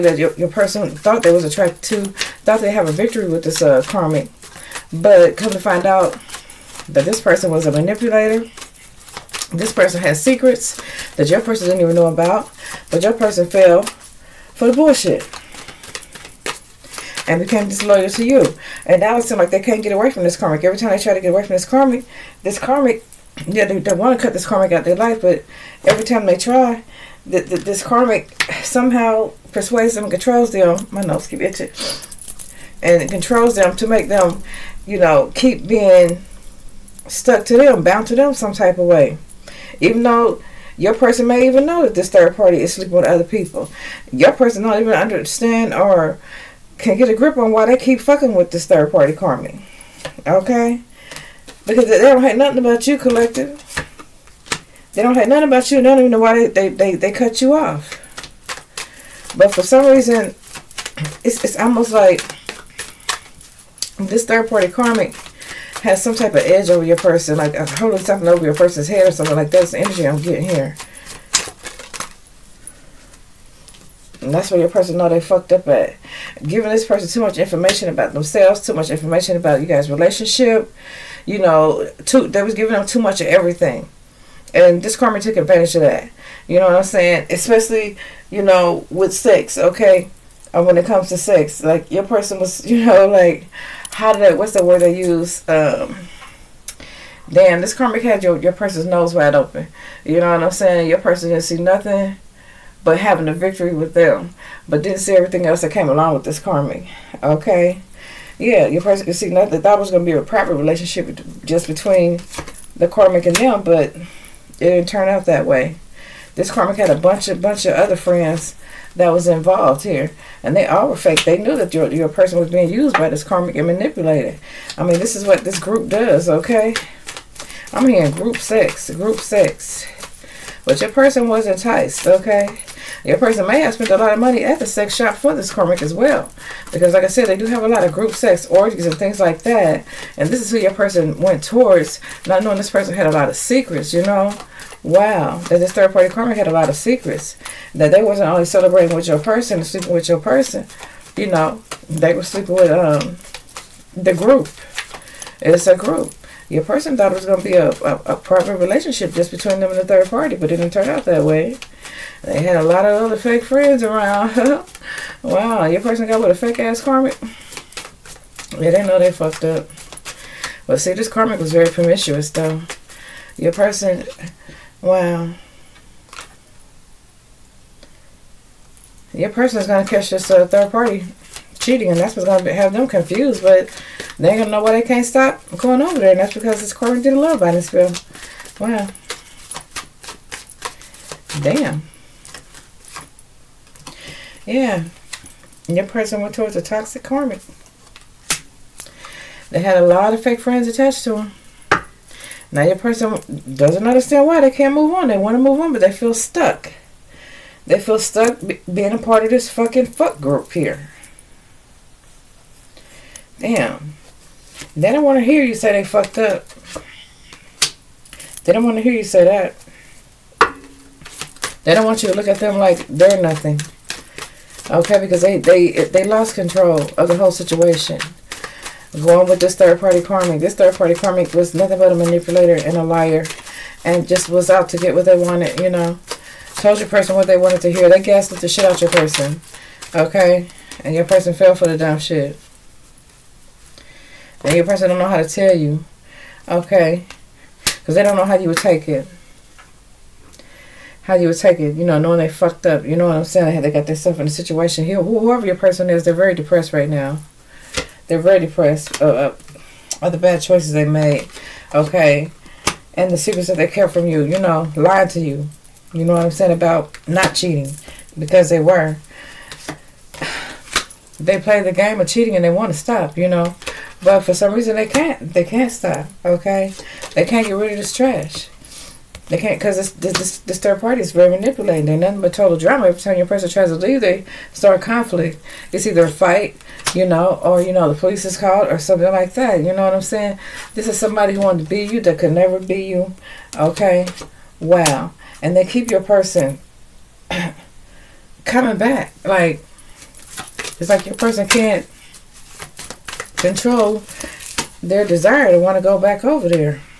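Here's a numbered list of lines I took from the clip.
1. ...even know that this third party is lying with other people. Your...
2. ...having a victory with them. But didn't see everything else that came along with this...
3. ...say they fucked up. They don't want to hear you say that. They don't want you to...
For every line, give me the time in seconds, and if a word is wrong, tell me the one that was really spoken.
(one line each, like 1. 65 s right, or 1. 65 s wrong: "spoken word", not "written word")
1. 41 s wrong: "sleeping", not "lying"
2. 102 s right
3. 215 s right.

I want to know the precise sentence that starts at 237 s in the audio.
They gaslit the shit out your person.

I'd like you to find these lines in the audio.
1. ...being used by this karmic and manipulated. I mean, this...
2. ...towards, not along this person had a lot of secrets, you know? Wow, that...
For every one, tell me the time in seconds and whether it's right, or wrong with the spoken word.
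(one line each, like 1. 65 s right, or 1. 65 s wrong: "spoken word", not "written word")
1. 122 s right
2. 141 s wrong: "knowing", not "along".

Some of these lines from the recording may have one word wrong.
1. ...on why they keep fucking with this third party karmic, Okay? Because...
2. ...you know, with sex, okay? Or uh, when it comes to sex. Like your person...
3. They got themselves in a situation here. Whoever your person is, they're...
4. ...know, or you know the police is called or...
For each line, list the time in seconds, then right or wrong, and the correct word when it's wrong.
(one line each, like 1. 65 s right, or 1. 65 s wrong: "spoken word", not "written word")
1. 47 s right
2. 88 s right
3. 253 s right
4. 287 s right.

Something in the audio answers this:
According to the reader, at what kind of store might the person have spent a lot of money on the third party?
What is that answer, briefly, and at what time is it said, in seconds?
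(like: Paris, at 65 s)
sex shop, at 134 s.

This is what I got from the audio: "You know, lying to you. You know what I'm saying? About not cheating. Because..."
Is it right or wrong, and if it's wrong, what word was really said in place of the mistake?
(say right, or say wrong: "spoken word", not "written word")
right.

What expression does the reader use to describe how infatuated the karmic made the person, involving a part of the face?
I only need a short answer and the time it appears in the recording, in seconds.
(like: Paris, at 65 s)
nose wide open, at 98 s.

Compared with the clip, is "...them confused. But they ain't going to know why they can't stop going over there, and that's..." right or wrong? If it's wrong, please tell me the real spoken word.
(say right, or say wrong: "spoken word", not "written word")
right.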